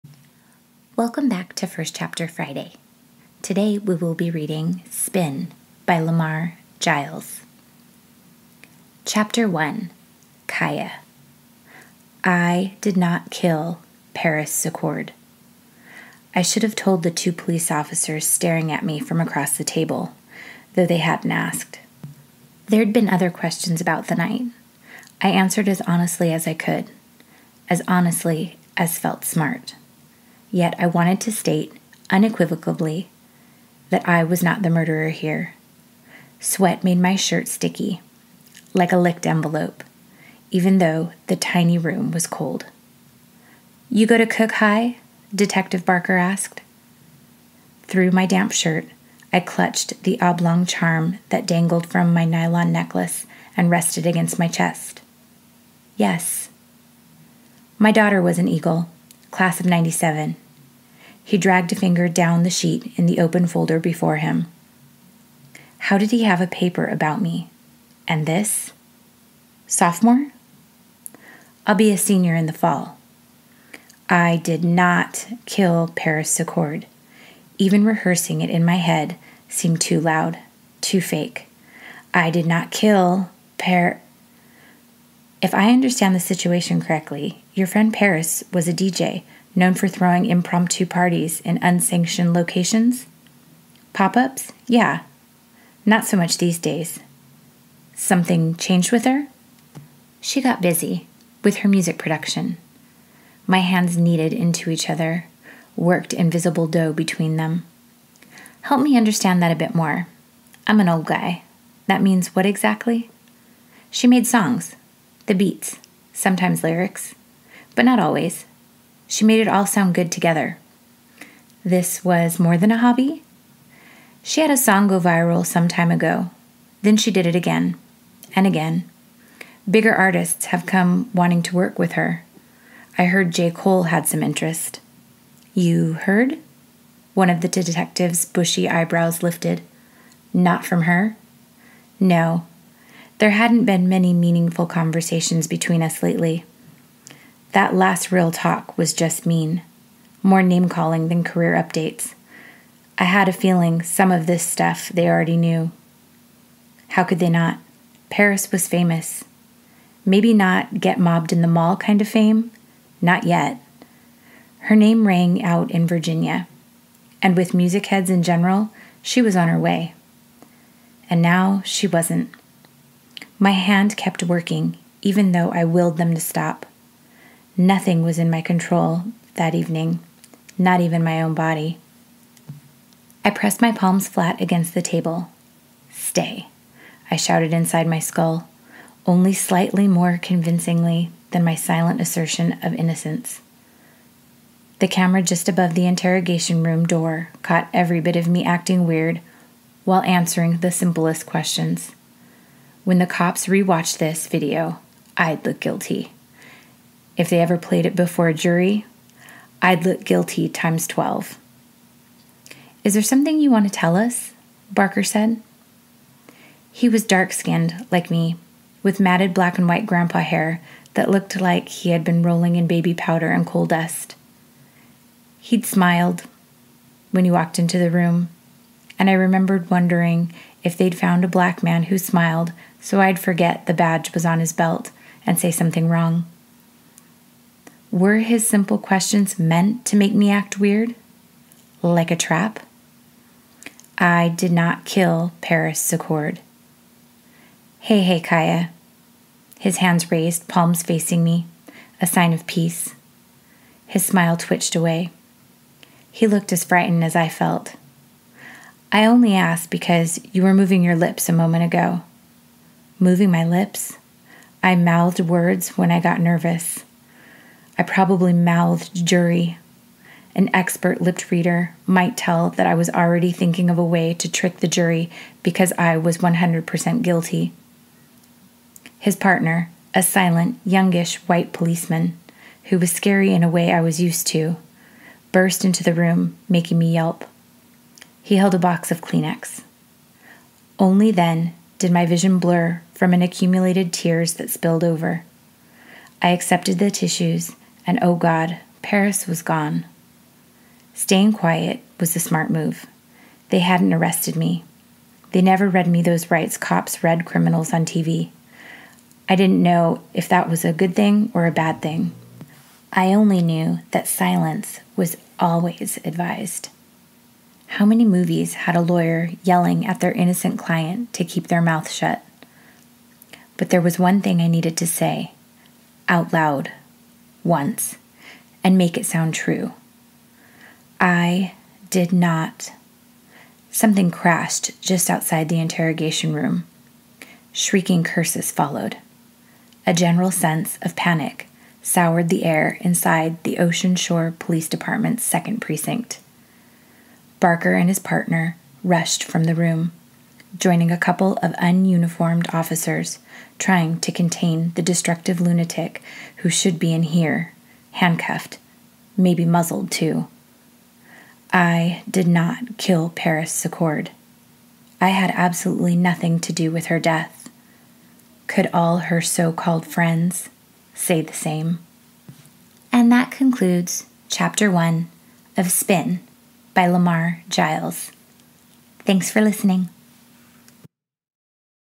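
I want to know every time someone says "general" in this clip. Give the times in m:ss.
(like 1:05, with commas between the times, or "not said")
2:48, 5:39.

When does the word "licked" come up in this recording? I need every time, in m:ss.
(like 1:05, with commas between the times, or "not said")
0:38.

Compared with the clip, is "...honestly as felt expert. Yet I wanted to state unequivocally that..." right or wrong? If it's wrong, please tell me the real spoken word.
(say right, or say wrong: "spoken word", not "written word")
wrong: "smart", not "expert".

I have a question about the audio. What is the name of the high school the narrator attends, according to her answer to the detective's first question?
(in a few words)
Cook High.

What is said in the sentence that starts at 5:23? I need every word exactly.
But there was one thing I needed to say out loud once and make it sound true.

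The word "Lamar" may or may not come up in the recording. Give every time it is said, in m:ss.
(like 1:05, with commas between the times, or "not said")
0:05, 6:16.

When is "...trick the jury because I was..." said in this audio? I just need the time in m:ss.
4:34.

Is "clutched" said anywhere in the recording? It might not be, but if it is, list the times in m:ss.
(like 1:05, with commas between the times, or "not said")
0:49.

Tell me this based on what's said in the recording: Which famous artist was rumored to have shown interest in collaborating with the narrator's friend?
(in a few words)
J. Cole.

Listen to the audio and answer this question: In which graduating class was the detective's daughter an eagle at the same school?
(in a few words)
class of 97.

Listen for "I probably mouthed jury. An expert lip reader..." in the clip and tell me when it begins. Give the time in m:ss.
4:27.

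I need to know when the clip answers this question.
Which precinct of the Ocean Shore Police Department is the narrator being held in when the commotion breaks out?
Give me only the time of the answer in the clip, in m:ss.
5:45.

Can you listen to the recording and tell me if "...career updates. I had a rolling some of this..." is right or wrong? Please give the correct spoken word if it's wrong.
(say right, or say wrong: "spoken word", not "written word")
wrong: "feeling", not "rolling".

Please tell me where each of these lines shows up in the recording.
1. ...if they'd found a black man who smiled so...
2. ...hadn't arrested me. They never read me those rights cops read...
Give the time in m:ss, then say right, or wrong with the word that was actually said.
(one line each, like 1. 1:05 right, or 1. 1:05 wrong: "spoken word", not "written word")
1. 3:50 right
2. 5:03 right.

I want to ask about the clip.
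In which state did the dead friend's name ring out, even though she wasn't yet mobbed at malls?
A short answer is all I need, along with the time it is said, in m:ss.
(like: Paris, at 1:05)
Virginia, at 2:45.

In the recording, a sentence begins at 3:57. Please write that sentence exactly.
Were his simple questions meant to make me act weird?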